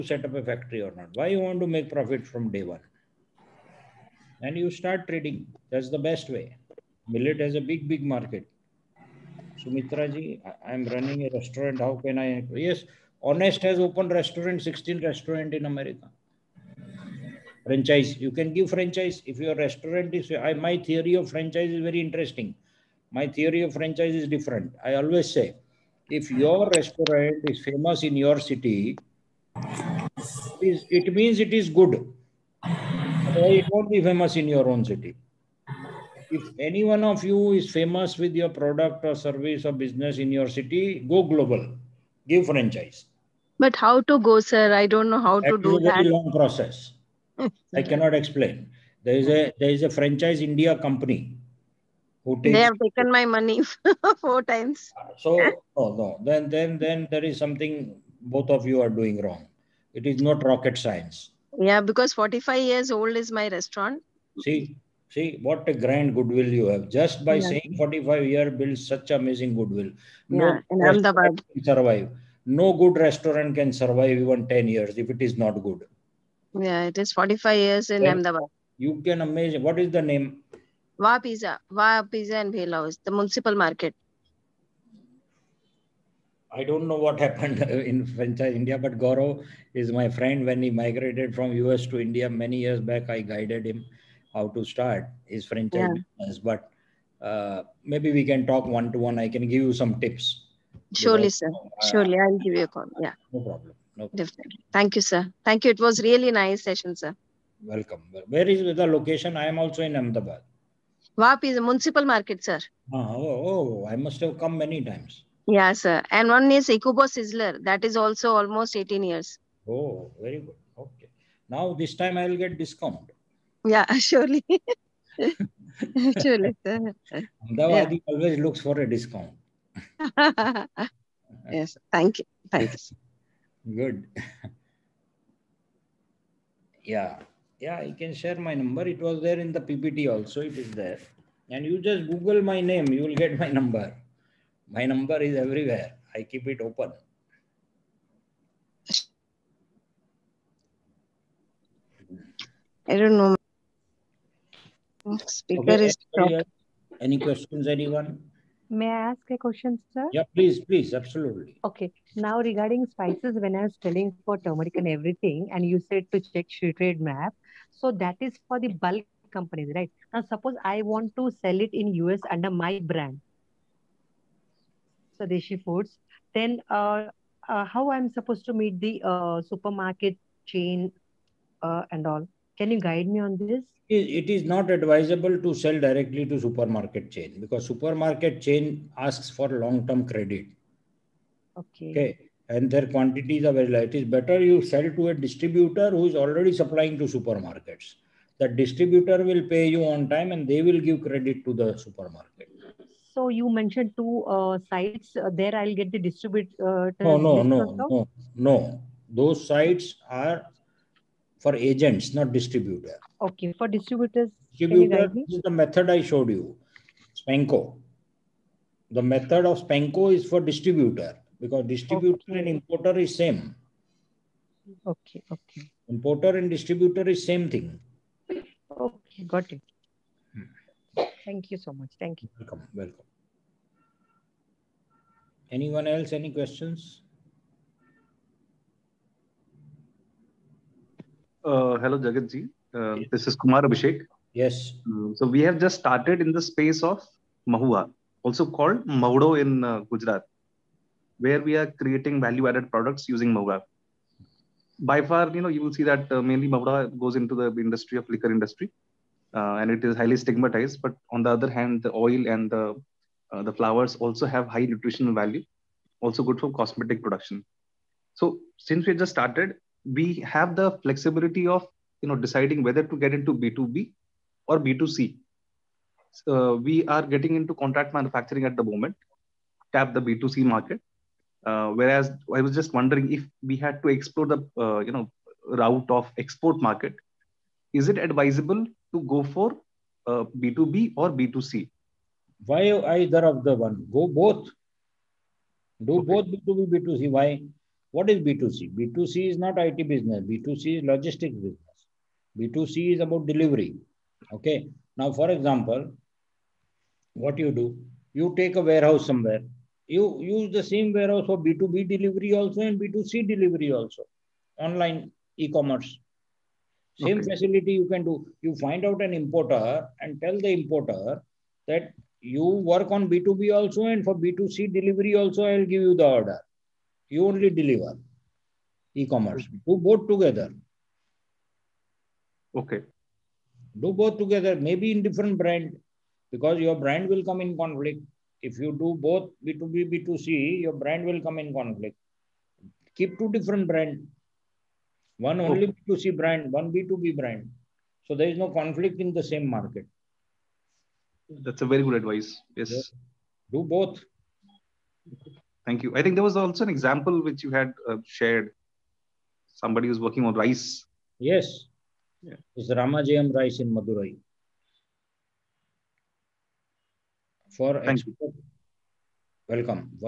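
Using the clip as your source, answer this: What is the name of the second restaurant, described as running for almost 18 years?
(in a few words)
Ikubo Sizzler.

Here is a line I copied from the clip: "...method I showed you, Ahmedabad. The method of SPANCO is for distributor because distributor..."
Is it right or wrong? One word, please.
wrong.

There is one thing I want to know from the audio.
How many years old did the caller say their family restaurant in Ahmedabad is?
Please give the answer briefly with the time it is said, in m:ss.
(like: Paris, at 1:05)
45, at 1:02.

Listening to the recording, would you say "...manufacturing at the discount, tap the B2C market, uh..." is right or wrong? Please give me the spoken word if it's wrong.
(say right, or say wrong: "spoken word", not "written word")
wrong: "moment", not "discount".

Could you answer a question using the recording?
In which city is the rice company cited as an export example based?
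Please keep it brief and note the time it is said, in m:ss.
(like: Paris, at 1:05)
Madurai, at 6:03.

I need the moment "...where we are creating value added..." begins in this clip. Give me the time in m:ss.
4:11.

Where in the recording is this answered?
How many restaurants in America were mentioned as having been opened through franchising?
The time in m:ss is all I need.
0:14.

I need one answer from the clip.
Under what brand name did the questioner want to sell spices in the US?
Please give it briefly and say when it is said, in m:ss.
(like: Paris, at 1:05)
Swadeshi Foods, at 2:55.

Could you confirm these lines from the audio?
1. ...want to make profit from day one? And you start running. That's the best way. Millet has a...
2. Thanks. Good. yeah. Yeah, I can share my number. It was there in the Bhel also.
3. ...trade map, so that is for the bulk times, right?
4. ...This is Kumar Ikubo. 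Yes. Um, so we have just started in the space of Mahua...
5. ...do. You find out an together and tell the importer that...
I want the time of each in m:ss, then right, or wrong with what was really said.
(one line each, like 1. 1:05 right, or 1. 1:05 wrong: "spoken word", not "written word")
1. 0:01 wrong: "trading", not "running"
2. 2:12 wrong: "PPT", not "Bhel"
3. 2:46 wrong: "companies", not "times"
4. 4:03 wrong: "Abhishek", not "Ikubo"
5. 5:18 wrong: "importer", not "together".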